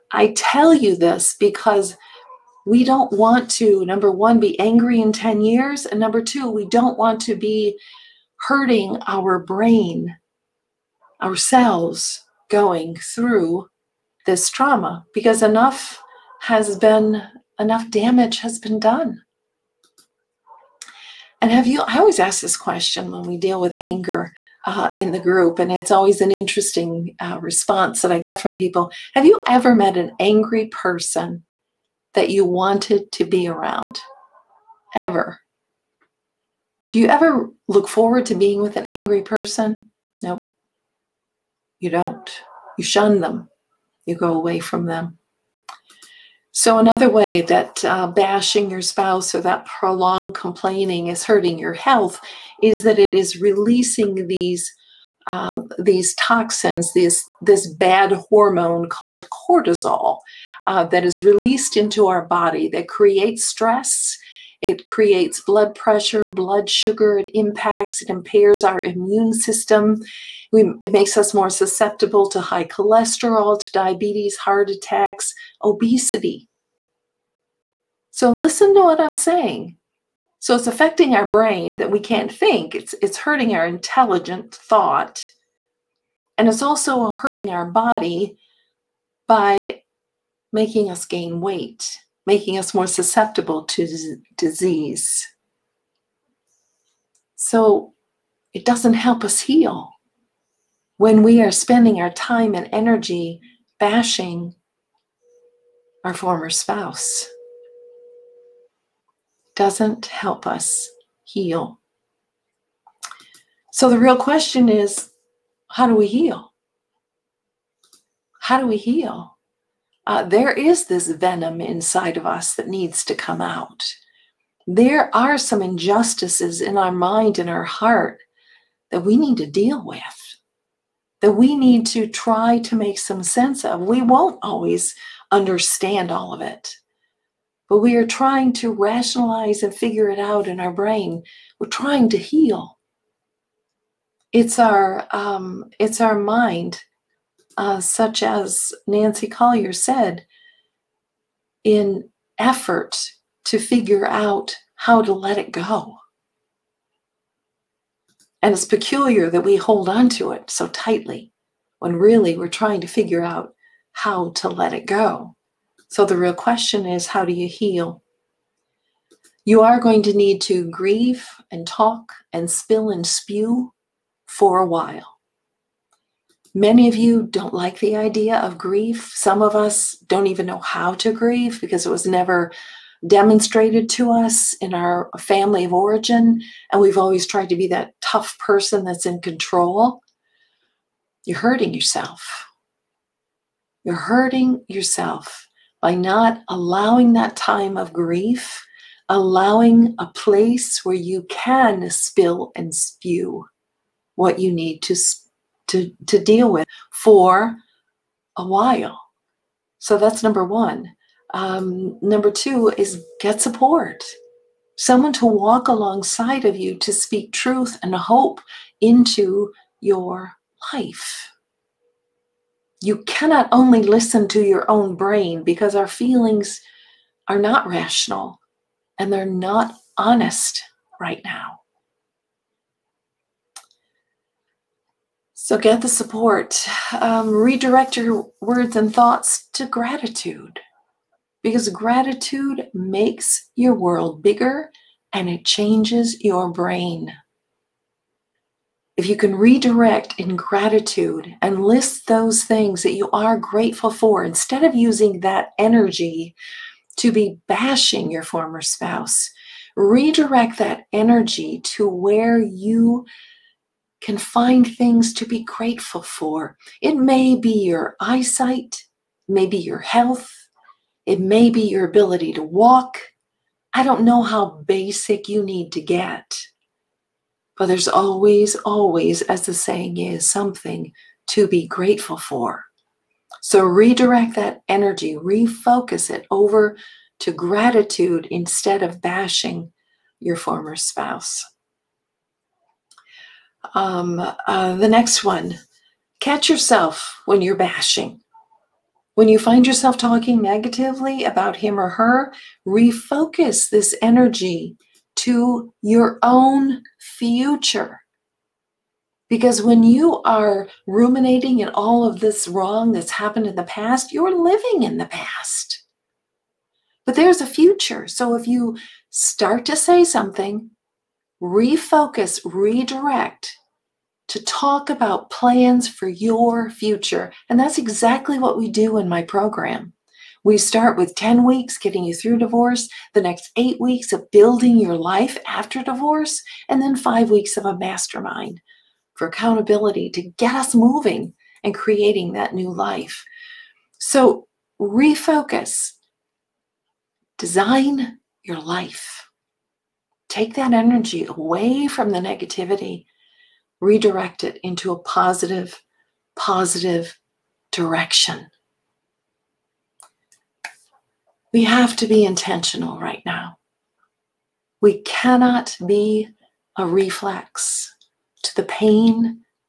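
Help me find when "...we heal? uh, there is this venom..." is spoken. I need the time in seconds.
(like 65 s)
118 s.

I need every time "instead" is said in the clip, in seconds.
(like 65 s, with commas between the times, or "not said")
254 s, 288 s.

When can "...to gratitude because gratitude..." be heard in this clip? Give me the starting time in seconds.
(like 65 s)
239 s.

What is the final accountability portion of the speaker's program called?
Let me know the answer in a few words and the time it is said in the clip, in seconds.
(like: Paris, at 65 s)
mastermind, at 337 s.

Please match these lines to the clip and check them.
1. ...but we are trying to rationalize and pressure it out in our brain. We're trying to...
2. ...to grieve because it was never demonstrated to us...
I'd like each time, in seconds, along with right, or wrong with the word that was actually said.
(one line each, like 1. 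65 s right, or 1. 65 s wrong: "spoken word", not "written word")
1. 137 s wrong: "figure", not "pressure"
2. 180 s right.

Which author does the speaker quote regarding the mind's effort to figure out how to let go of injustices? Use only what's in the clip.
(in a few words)
Nancy Collier.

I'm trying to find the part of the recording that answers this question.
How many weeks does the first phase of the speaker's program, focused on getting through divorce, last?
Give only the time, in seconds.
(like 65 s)
331 s.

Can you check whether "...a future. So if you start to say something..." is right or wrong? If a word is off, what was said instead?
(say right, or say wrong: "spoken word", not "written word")
right.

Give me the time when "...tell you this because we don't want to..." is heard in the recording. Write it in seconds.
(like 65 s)
0 s.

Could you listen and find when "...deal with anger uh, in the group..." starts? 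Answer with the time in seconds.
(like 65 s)
23 s.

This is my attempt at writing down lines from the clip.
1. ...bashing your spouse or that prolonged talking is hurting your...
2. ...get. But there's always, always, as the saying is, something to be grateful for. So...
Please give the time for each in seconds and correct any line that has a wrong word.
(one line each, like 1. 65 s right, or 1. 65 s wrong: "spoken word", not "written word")
1. 48 s wrong: "complaining", not "talking"
2. 275 s right.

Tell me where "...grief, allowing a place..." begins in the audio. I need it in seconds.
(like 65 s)
197 s.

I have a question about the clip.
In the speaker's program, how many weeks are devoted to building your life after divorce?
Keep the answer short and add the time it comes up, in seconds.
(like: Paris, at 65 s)
8, at 333 s.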